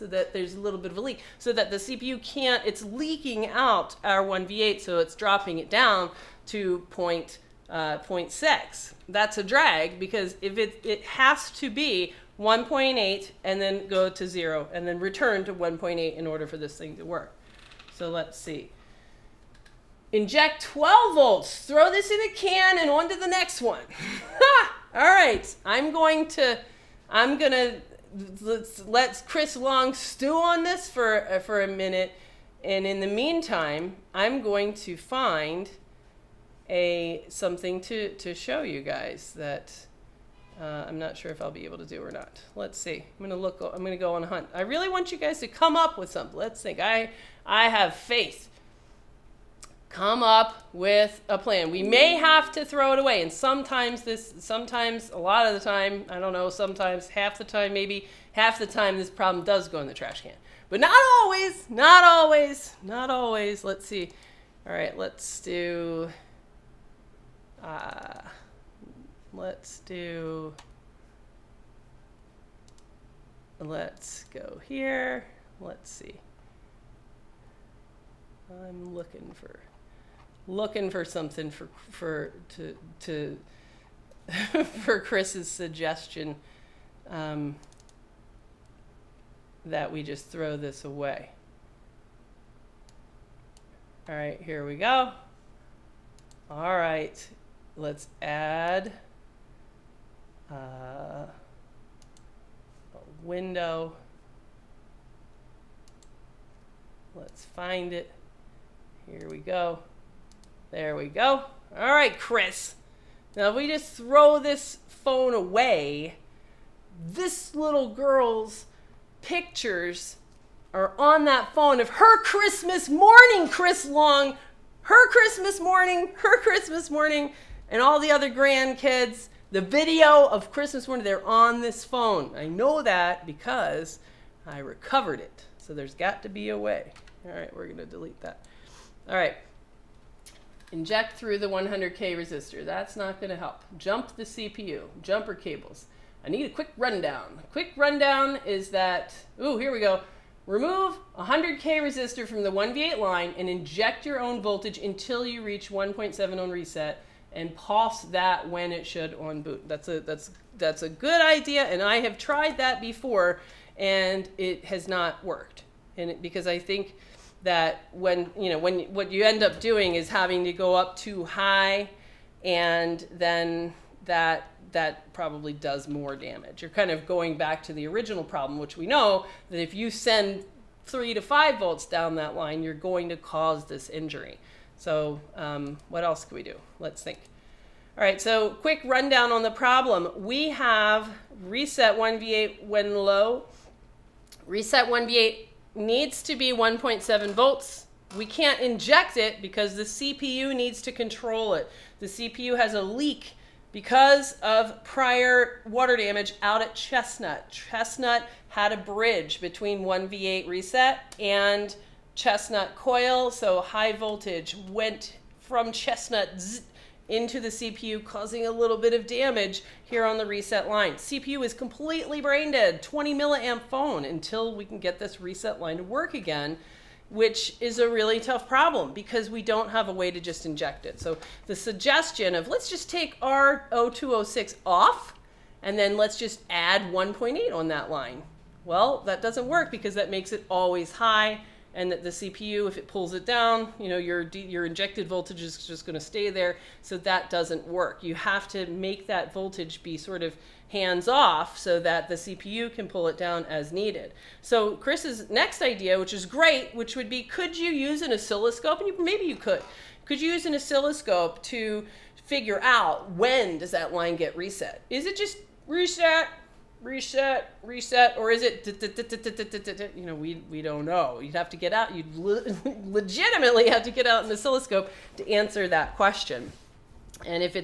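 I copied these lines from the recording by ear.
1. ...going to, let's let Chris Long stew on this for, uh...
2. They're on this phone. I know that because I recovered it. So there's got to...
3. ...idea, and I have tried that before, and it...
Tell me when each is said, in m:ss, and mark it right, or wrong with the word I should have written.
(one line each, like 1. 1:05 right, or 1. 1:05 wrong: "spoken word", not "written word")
1. 0:27 right
2. 2:11 right
3. 2:41 right.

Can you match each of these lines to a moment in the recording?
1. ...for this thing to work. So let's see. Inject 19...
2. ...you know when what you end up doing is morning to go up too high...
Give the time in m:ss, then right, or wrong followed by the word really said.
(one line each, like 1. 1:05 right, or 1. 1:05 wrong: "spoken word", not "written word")
1. 0:16 wrong: "12", not "19"
2. 2:48 wrong: "having", not "morning".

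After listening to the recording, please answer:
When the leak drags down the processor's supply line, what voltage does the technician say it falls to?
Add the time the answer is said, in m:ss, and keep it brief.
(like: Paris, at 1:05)
0.6, at 0:07.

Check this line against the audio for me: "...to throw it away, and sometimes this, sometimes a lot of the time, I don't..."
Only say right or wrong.
right.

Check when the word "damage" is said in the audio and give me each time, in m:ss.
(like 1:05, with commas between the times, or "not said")
2:56, 3:25, 3:39.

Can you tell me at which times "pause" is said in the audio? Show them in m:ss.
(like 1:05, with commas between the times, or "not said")
2:37.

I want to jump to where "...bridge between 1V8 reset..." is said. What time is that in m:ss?
3:28.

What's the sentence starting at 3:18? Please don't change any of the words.
We can't inject it because the CPU needs to control it.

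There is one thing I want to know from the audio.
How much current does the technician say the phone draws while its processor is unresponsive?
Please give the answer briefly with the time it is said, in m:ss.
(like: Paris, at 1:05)
20 milliamps, at 3:42.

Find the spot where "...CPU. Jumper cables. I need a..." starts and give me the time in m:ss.
2:24.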